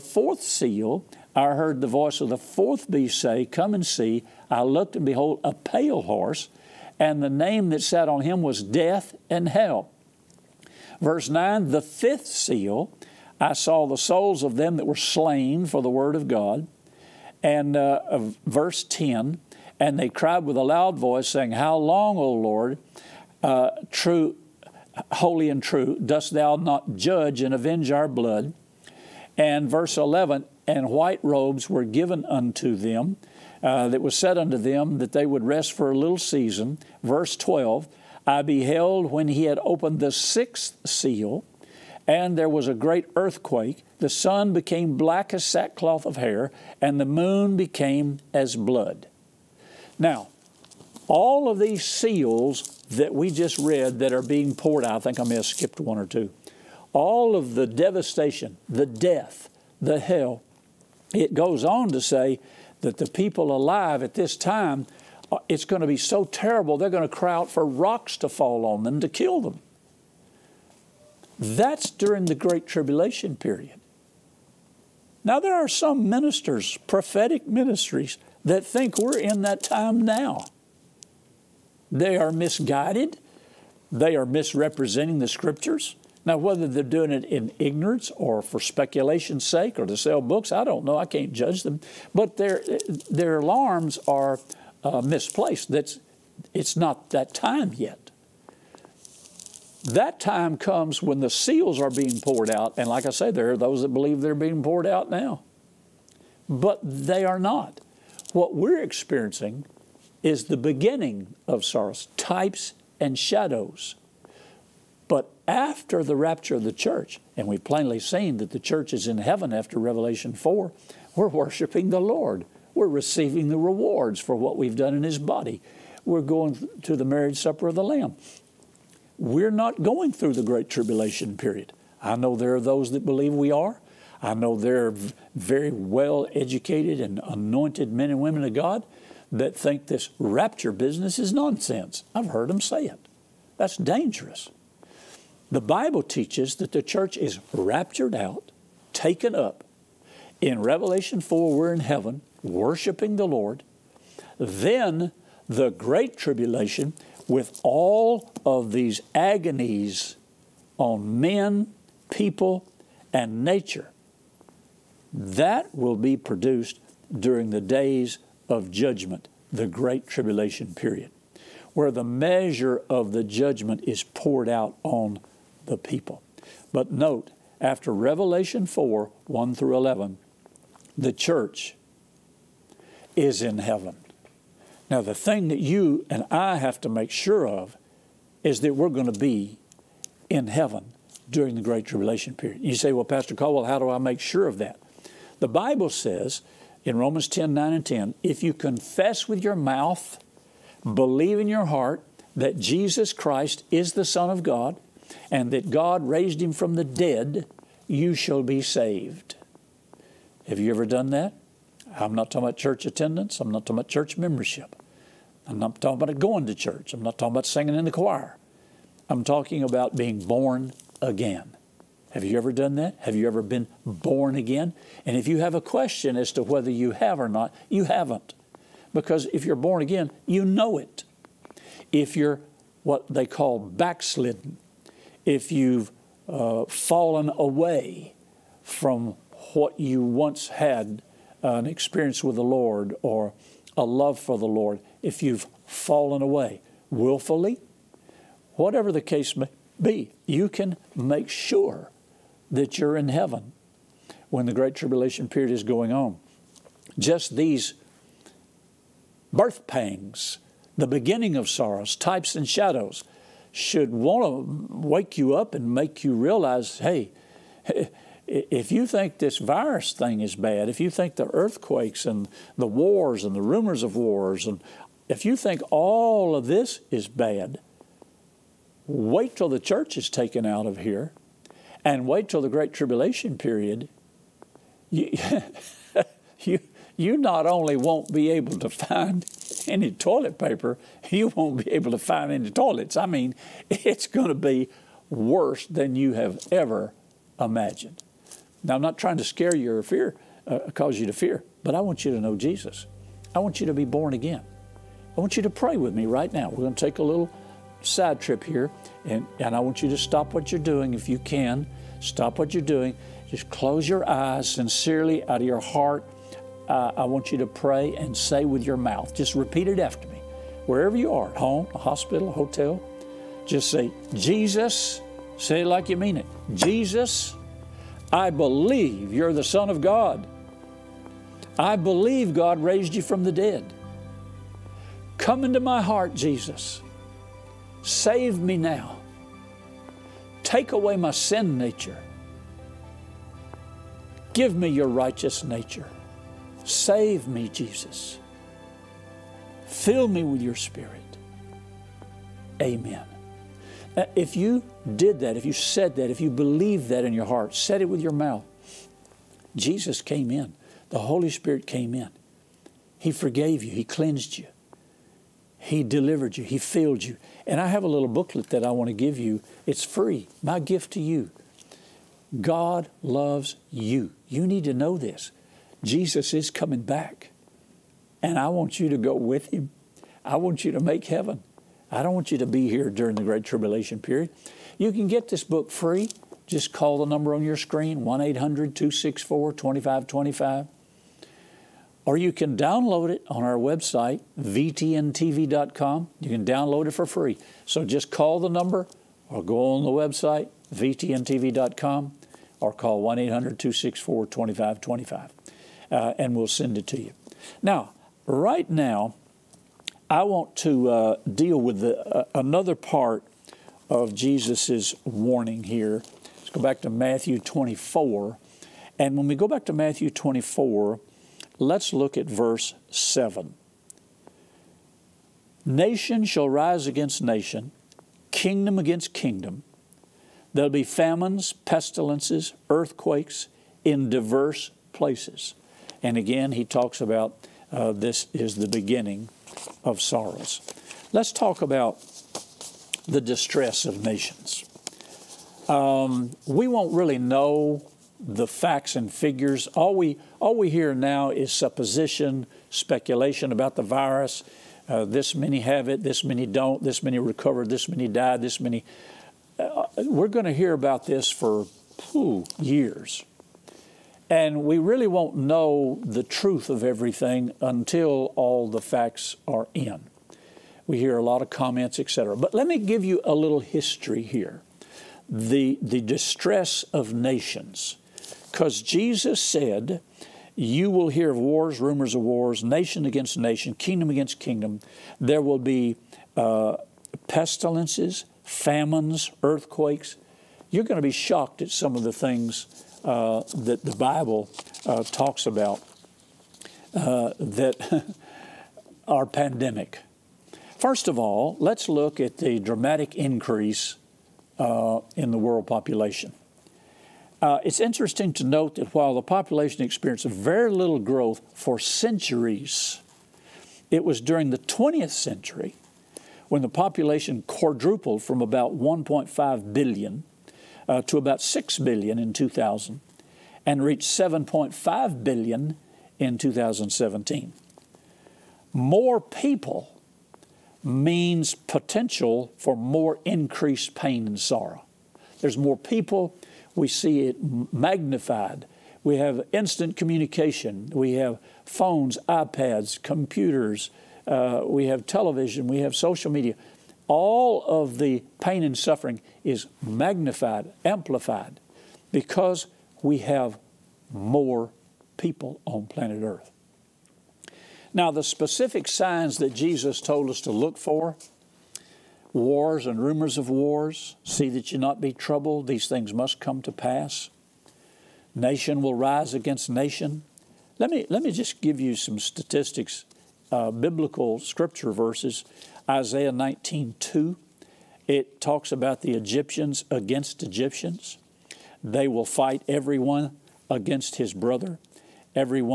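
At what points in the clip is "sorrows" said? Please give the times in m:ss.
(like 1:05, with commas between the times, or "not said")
1:51, 4:21, 7:20, 8:54.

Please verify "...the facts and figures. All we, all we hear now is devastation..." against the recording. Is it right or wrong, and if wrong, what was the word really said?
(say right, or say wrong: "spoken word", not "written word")
wrong: "supposition", not "devastation".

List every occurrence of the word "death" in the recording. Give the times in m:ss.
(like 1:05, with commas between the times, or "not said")
0:08, 0:58.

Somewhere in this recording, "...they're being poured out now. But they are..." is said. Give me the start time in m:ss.
1:44.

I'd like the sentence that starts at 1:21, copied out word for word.
They are misguided, they are misrepresenting the scriptures.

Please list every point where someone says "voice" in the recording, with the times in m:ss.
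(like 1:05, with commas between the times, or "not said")
0:01, 0:20.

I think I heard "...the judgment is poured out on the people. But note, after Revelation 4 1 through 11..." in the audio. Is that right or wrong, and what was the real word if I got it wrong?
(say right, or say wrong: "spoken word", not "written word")
right.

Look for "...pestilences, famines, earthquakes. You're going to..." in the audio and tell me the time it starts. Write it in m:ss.
8:07.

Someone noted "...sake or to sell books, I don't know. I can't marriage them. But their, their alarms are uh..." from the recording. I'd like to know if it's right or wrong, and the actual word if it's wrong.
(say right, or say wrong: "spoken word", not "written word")
wrong: "judge", not "marriage".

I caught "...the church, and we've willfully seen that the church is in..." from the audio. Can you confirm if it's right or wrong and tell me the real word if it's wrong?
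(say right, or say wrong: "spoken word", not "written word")
wrong: "plainly", not "willfully".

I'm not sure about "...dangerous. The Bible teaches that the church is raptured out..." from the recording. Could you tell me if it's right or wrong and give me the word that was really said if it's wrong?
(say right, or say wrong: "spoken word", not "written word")
right.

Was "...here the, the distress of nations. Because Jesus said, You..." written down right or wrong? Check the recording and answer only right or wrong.
right.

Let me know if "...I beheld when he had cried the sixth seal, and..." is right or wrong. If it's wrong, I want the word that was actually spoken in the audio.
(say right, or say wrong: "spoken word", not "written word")
wrong: "opened", not "cried".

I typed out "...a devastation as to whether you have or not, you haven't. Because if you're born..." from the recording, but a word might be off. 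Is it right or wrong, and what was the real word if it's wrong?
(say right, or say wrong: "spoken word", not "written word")
wrong: "question", not "devastation".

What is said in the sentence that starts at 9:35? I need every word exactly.
Isaiah 19:2, it talks about the Egyptians against Egyptians.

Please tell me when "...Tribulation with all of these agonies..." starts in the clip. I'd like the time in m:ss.
2:36.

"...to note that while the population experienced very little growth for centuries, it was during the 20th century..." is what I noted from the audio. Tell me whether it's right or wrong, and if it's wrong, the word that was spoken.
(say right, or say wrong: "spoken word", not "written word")
right.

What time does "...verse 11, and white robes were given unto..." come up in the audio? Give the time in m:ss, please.
0:29.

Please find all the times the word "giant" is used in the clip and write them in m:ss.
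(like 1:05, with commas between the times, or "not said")
not said.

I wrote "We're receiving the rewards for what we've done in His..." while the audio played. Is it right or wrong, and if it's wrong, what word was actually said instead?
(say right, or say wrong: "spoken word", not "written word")
right.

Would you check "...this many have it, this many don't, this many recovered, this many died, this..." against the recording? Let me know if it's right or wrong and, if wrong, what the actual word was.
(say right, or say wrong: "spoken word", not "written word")
right.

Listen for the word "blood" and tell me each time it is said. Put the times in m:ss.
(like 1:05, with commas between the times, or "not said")
0:28, 0:48.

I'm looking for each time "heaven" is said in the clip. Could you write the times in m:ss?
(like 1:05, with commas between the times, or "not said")
1:59, 2:31, 3:03, 3:10, 4:13, 6:21.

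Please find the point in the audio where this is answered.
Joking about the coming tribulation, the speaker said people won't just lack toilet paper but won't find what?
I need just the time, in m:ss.
4:52.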